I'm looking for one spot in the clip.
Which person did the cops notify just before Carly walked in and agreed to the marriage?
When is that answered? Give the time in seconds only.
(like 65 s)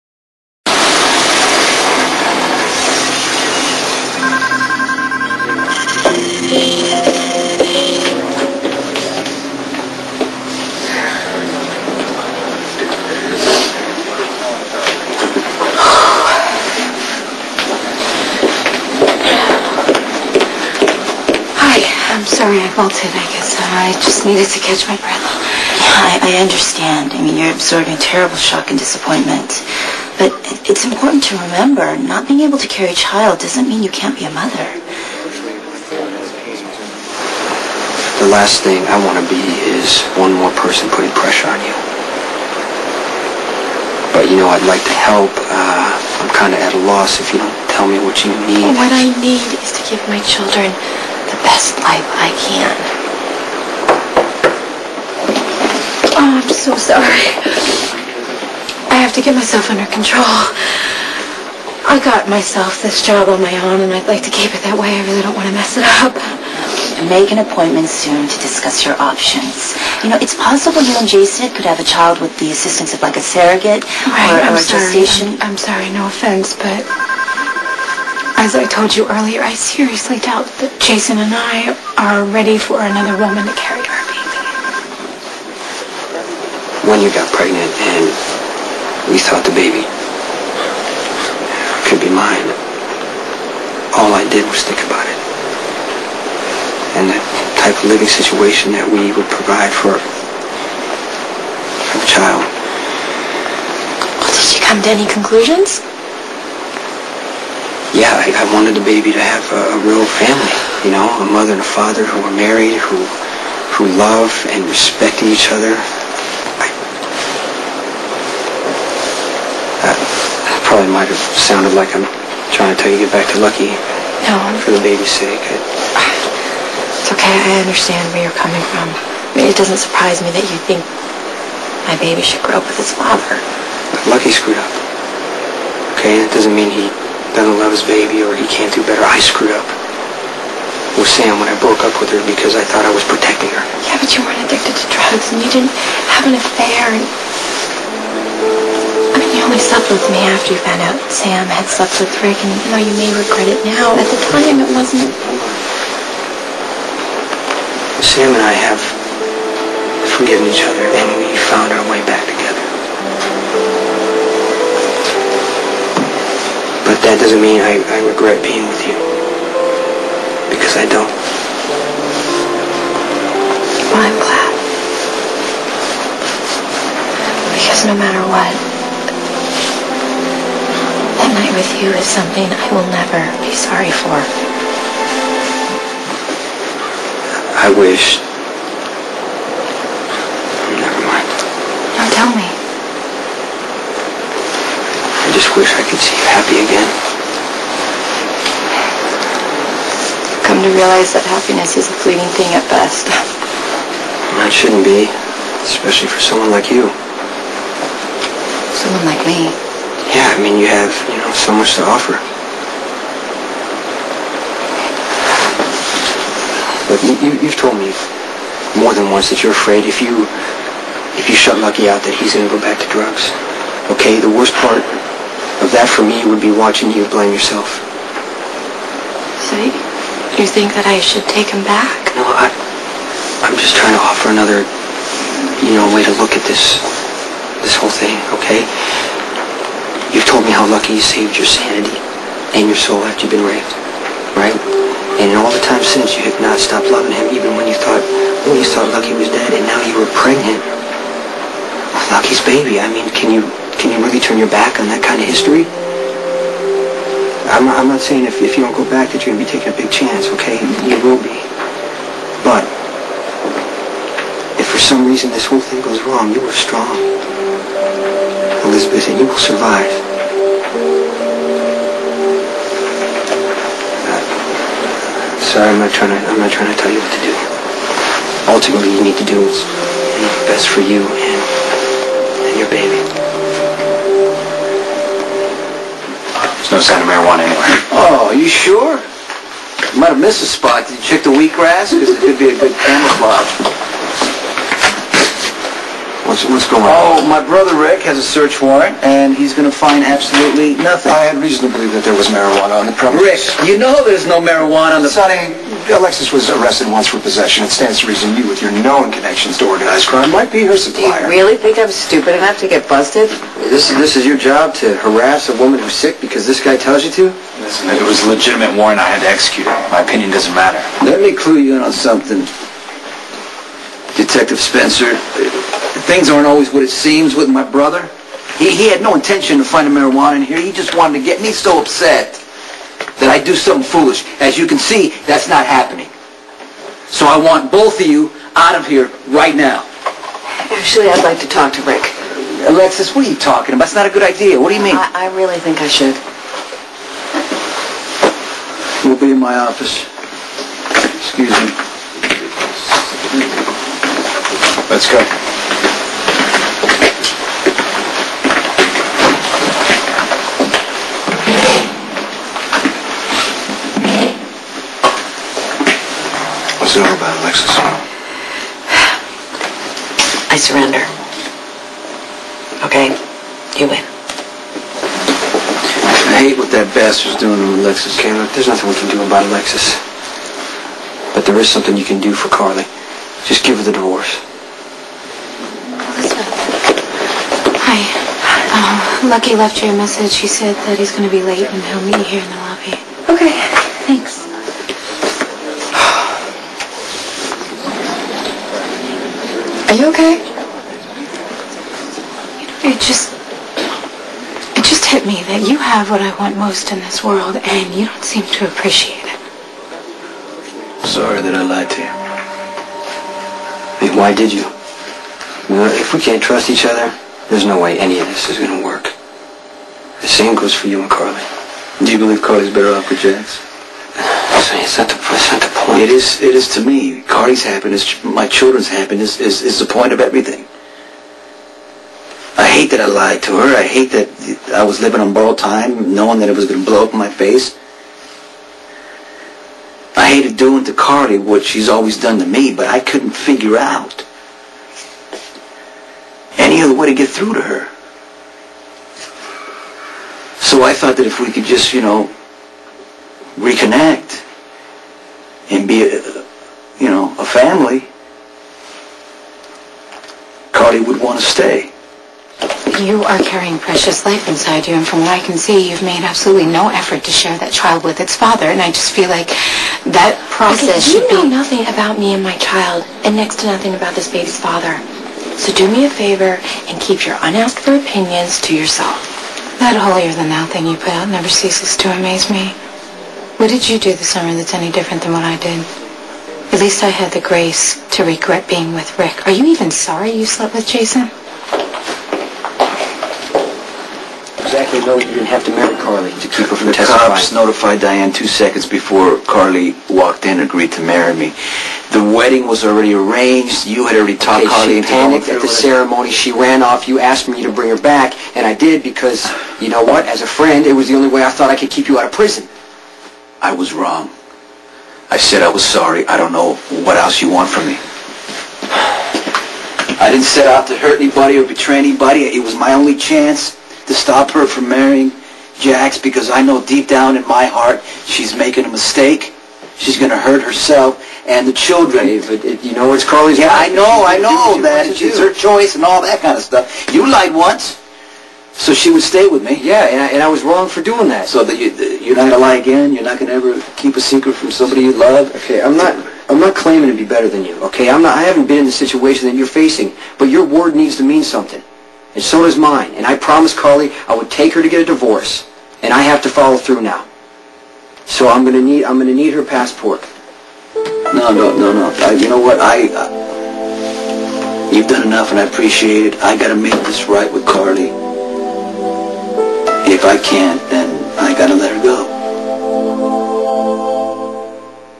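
497 s.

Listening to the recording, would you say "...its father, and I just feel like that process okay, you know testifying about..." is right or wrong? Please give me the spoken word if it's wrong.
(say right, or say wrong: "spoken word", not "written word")
wrong: "nothing", not "testifying".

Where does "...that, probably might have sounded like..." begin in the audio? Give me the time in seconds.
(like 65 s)
119 s.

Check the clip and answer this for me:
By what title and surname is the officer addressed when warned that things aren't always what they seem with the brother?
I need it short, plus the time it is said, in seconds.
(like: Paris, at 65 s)
Detective Spencer, at 324 s.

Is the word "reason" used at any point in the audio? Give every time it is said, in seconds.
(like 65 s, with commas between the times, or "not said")
265 s, 301 s, 308 s.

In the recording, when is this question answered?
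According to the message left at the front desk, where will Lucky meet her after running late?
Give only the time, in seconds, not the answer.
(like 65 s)
392 s.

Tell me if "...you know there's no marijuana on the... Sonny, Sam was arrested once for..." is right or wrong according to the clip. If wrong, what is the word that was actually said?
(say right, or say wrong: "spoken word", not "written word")
wrong: "Alexis", not "Sam".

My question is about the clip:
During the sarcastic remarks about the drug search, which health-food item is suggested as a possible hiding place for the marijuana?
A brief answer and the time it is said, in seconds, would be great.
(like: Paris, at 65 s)
Wheatgrass, at 291 s.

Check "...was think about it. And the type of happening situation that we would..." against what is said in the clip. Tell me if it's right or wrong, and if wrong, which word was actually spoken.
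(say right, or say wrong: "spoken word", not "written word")
wrong: "living", not "happening".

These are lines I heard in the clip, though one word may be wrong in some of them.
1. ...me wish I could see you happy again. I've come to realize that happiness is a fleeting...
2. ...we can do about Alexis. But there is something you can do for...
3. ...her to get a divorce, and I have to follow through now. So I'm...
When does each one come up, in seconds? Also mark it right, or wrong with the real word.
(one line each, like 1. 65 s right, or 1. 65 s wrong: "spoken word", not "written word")
1. 192 s right
2. 378 s right
3. 554 s right.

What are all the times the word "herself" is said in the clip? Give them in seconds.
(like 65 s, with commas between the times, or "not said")
530 s.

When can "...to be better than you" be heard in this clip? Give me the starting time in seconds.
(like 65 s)
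547 s.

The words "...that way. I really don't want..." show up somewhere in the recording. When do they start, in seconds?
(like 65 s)
64 s.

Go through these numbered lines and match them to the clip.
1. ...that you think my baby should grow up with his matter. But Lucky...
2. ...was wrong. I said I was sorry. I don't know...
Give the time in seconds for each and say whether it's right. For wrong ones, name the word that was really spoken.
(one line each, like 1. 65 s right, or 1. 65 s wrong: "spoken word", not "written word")
1. 130 s wrong: "father", not "matter"
2. 513 s right.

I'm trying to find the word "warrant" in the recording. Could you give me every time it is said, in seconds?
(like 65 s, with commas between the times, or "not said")
298 s, 318 s.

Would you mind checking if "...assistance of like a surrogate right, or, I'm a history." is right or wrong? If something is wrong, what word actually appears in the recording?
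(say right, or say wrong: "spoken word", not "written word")
wrong: "sorry", not "history".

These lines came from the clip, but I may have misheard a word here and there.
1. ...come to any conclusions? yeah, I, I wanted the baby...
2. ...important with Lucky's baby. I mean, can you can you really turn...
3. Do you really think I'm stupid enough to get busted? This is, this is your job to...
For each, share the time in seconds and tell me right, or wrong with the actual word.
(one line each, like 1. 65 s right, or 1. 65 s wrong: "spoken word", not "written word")
1. 104 s right
2. 250 s wrong: "pregnant", not "important"
3. 311 s right.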